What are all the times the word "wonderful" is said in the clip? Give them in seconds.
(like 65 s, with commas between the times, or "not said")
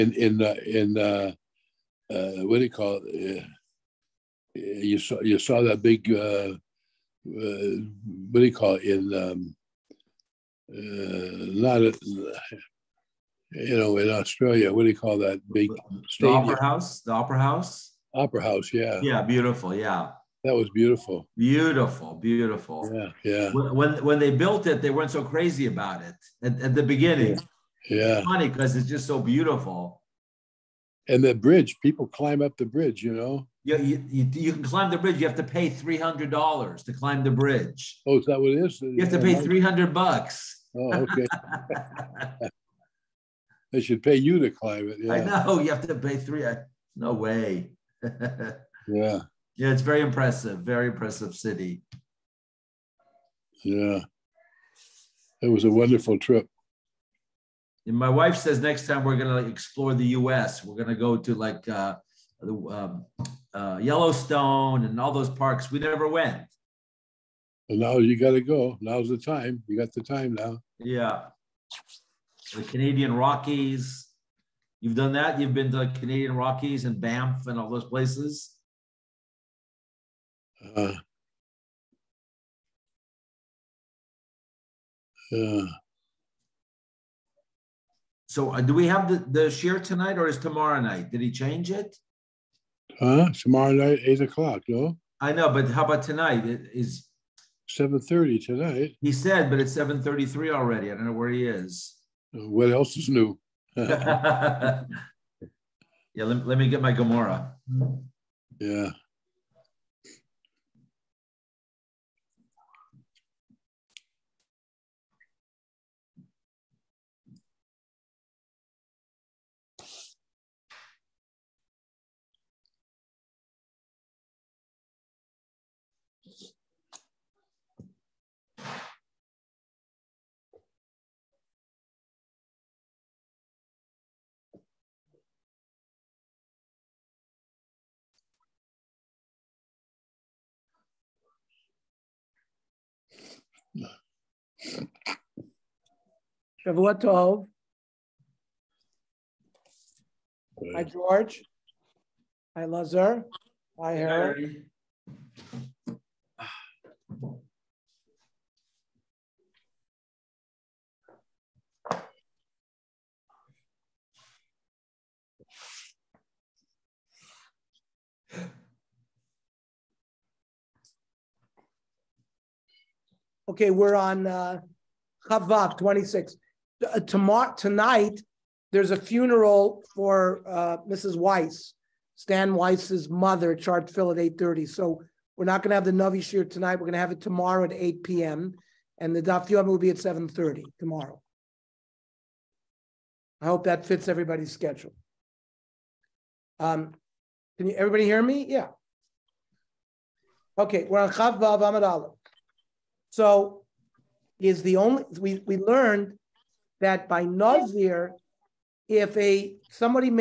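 55 s.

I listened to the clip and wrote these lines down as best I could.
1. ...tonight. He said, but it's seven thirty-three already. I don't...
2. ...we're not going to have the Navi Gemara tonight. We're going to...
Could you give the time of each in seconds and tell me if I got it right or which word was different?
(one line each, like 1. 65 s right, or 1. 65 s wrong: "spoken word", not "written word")
1. 98 s right
2. 185 s wrong: "Shir", not "Gemara".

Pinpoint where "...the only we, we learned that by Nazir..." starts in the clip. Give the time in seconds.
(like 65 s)
204 s.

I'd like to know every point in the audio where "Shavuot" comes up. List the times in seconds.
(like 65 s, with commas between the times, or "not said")
146 s.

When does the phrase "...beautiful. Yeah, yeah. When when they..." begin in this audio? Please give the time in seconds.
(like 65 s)
22 s.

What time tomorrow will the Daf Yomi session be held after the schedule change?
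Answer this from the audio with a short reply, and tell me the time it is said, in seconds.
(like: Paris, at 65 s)
7:30, at 189 s.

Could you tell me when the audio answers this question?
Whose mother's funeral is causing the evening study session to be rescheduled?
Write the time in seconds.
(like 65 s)
182 s.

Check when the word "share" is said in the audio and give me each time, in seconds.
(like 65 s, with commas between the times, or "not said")
89 s.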